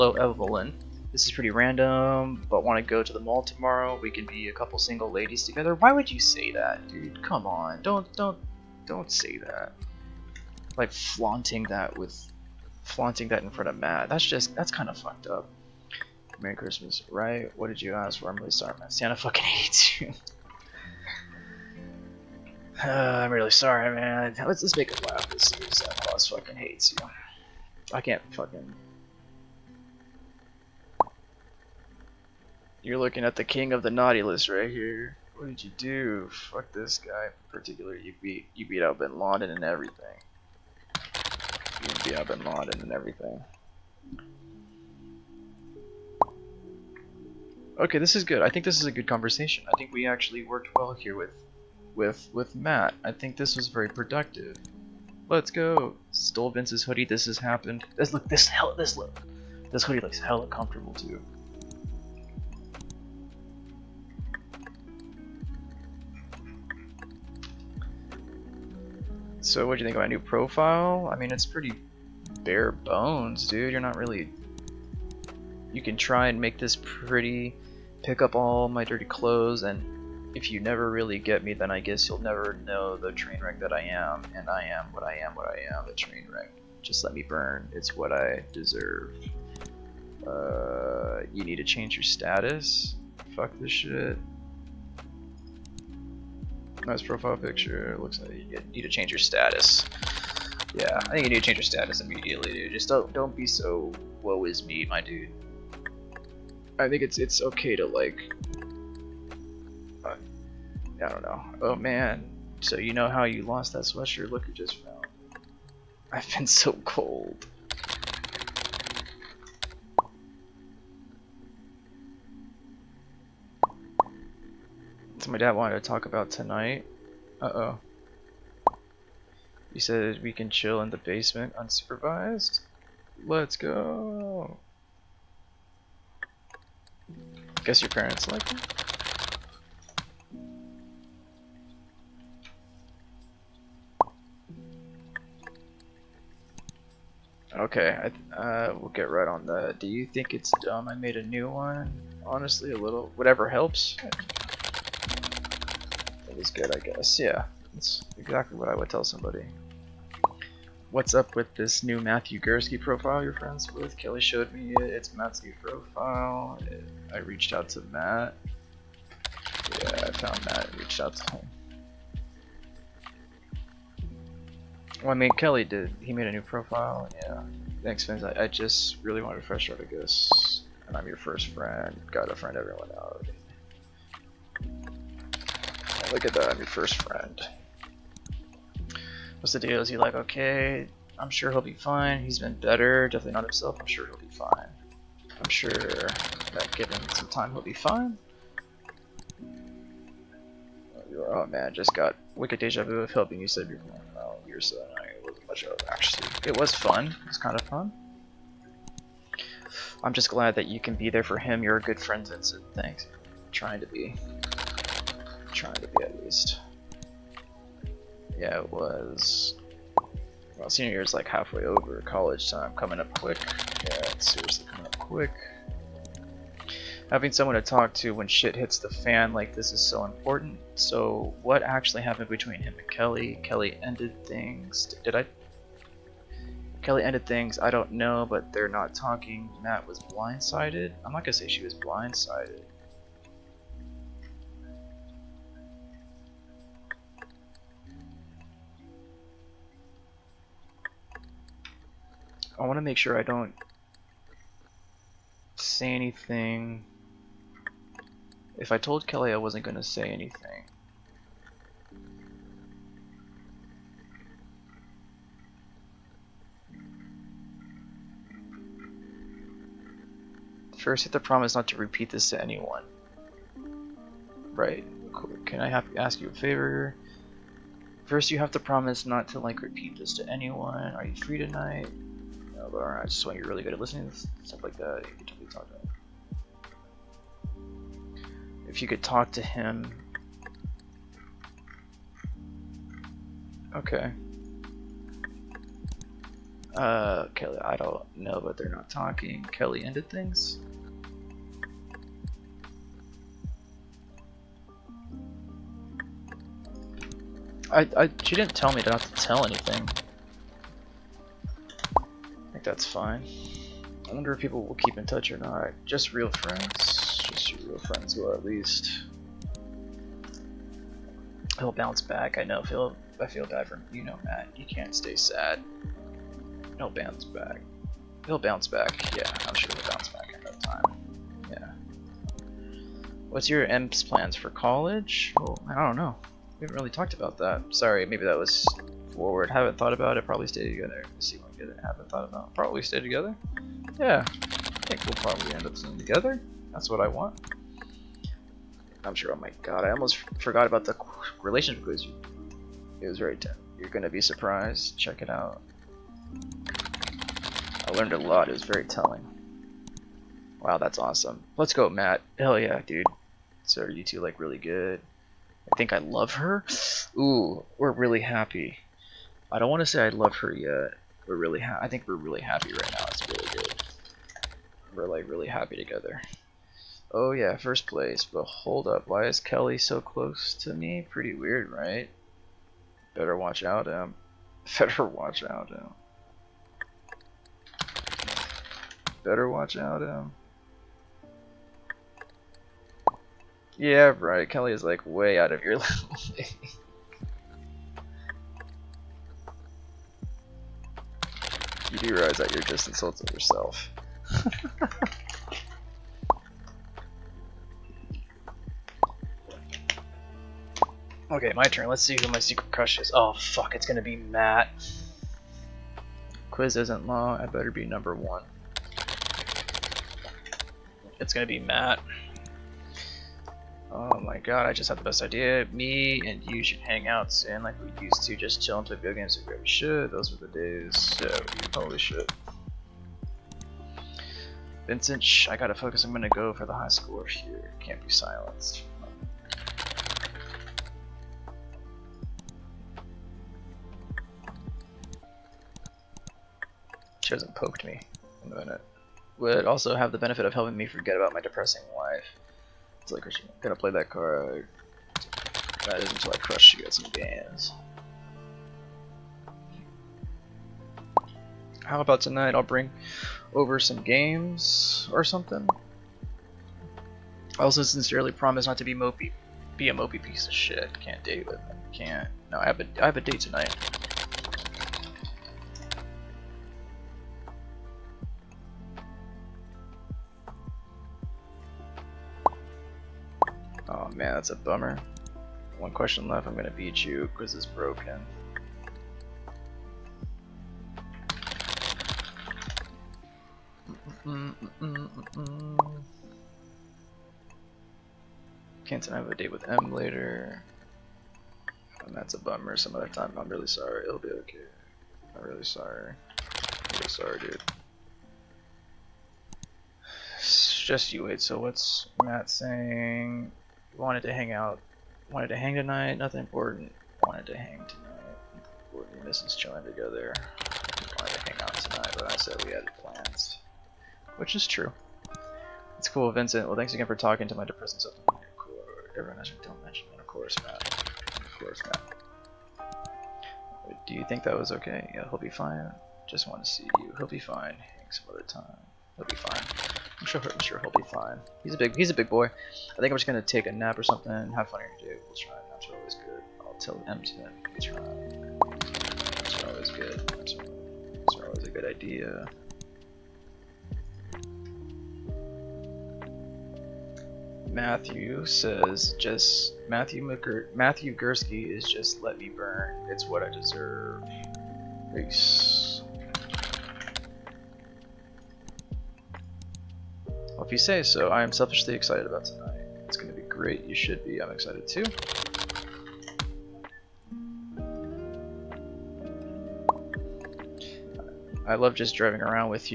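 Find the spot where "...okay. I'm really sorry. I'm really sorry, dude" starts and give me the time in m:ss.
8:24.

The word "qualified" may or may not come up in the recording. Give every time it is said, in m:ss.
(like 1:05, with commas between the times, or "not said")
not said.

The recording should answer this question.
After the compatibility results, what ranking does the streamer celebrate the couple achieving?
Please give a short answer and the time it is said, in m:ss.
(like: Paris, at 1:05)
First place, at 6:17.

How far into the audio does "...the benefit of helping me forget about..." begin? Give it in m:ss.
7:30.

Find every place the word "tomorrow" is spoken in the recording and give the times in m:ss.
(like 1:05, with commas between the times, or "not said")
0:03.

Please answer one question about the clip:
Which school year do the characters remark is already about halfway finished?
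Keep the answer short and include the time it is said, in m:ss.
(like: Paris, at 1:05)
Senior year, at 3:40.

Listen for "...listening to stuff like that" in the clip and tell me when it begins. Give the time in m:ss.
4:43.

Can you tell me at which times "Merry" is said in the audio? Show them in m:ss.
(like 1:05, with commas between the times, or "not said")
0:16.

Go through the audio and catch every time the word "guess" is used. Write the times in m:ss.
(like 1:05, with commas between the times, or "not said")
1:21, 2:17, 2:36.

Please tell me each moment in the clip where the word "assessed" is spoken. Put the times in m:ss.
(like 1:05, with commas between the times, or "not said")
not said.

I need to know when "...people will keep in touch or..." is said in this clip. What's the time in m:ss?
5:14.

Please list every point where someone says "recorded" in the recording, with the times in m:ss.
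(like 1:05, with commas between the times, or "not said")
not said.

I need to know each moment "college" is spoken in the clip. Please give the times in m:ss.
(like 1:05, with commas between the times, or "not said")
3:42, 5:34.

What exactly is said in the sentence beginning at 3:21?
Oh man, just got wicked deja vu of helping you save your phone.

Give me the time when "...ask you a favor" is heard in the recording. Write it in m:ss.
4:35.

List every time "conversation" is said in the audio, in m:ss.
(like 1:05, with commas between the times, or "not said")
0:49.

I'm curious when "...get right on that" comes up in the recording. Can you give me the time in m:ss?
2:28.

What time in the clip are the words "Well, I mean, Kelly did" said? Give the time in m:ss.
2:55.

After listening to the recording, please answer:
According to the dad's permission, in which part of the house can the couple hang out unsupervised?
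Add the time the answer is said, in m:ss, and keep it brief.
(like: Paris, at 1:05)
Basement, at 2:10.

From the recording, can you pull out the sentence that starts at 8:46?
Well, thanks again for talking to my depressing self.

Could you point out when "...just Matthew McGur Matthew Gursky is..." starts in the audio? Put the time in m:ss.
9:19.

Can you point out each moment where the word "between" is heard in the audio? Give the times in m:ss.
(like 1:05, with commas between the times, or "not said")
3:52.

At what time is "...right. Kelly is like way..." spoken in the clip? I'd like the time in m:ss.
6:34.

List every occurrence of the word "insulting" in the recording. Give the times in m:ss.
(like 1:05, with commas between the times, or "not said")
6:42.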